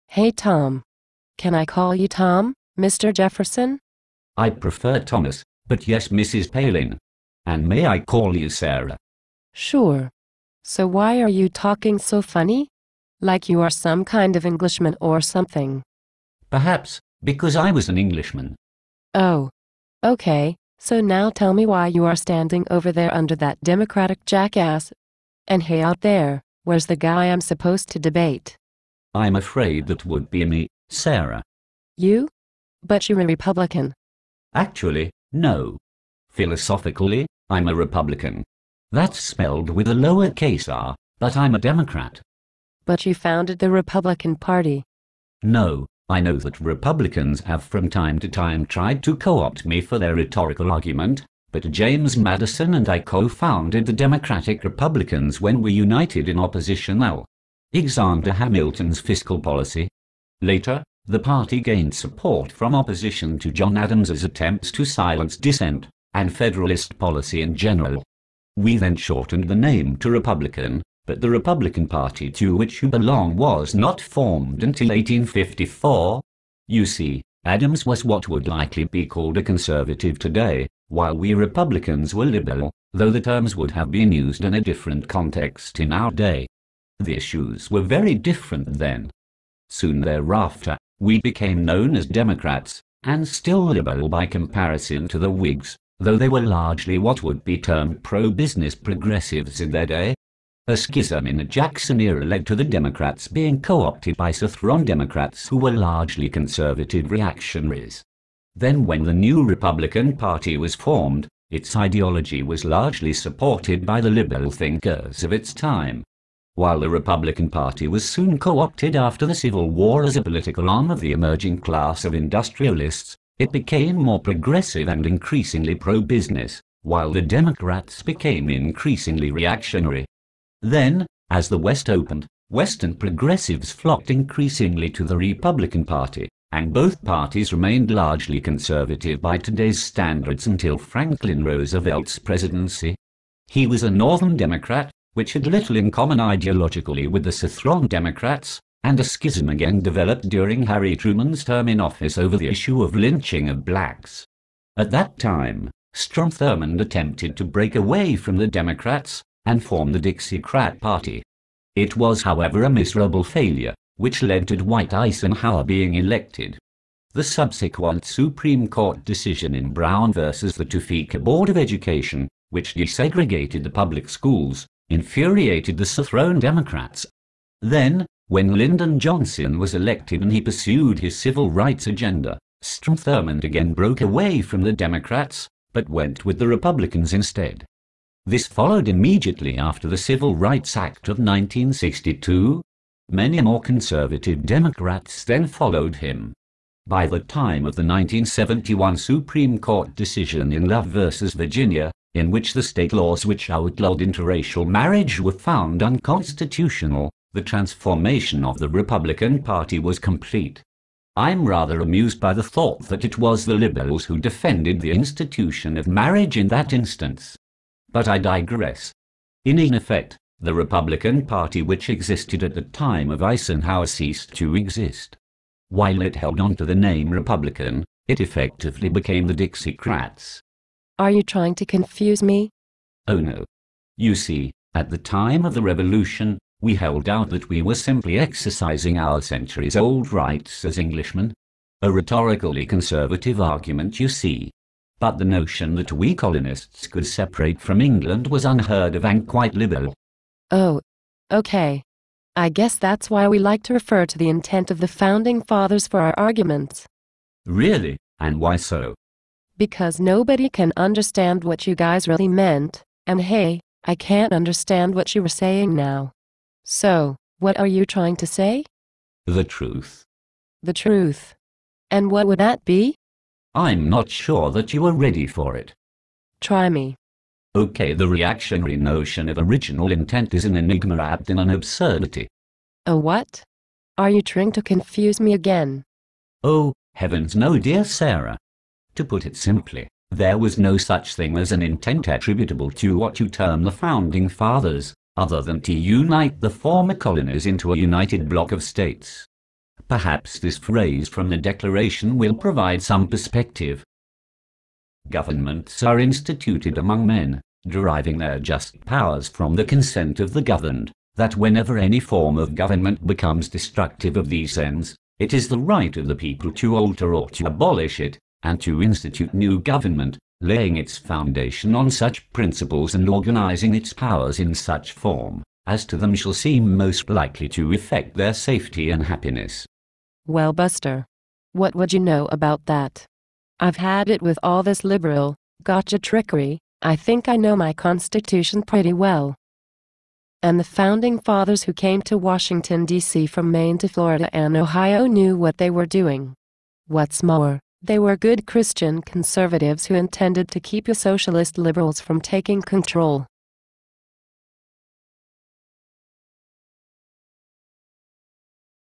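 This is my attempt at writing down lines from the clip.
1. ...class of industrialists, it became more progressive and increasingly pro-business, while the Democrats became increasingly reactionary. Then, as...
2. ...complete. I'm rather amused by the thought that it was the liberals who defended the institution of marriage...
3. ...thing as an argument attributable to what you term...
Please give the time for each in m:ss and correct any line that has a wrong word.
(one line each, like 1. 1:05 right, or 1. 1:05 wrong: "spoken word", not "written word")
1. 2:01 right
2. 3:29 right
3. 4:51 wrong: "intent", not "argument".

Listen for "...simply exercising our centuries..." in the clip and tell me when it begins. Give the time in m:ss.
3:57.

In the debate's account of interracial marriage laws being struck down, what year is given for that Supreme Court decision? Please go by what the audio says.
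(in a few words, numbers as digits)
1971.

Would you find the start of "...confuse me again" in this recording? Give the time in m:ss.
4:44.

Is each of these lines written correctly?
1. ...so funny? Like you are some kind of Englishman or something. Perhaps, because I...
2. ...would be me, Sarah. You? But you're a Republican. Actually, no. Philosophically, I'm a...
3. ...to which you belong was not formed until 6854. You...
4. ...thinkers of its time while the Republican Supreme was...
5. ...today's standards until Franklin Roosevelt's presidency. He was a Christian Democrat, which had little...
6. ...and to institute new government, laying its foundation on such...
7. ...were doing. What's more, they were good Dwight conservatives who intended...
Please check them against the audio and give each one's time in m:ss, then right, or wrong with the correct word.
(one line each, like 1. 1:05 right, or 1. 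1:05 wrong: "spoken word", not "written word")
1. 0:11 right
2. 0:30 right
3. 1:12 wrong: "1854", not "6854"
4. 1:54 wrong: "Party", not "Supreme"
5. 2:19 wrong: "Northern", not "Christian"
6. 5:18 right
7. 5:45 wrong: "Christian", not "Dwight".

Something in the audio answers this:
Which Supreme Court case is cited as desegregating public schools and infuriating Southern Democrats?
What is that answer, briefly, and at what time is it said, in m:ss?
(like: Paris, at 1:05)
Brown versus the Topeka Board of Education, at 2:49.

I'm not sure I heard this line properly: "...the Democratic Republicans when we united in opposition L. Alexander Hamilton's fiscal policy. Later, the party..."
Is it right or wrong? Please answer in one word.
right.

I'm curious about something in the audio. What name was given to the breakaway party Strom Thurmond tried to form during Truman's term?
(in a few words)
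Dixiecrat Party.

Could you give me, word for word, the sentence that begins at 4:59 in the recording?
Perhaps this phrase from the Declaration will provide some perspective.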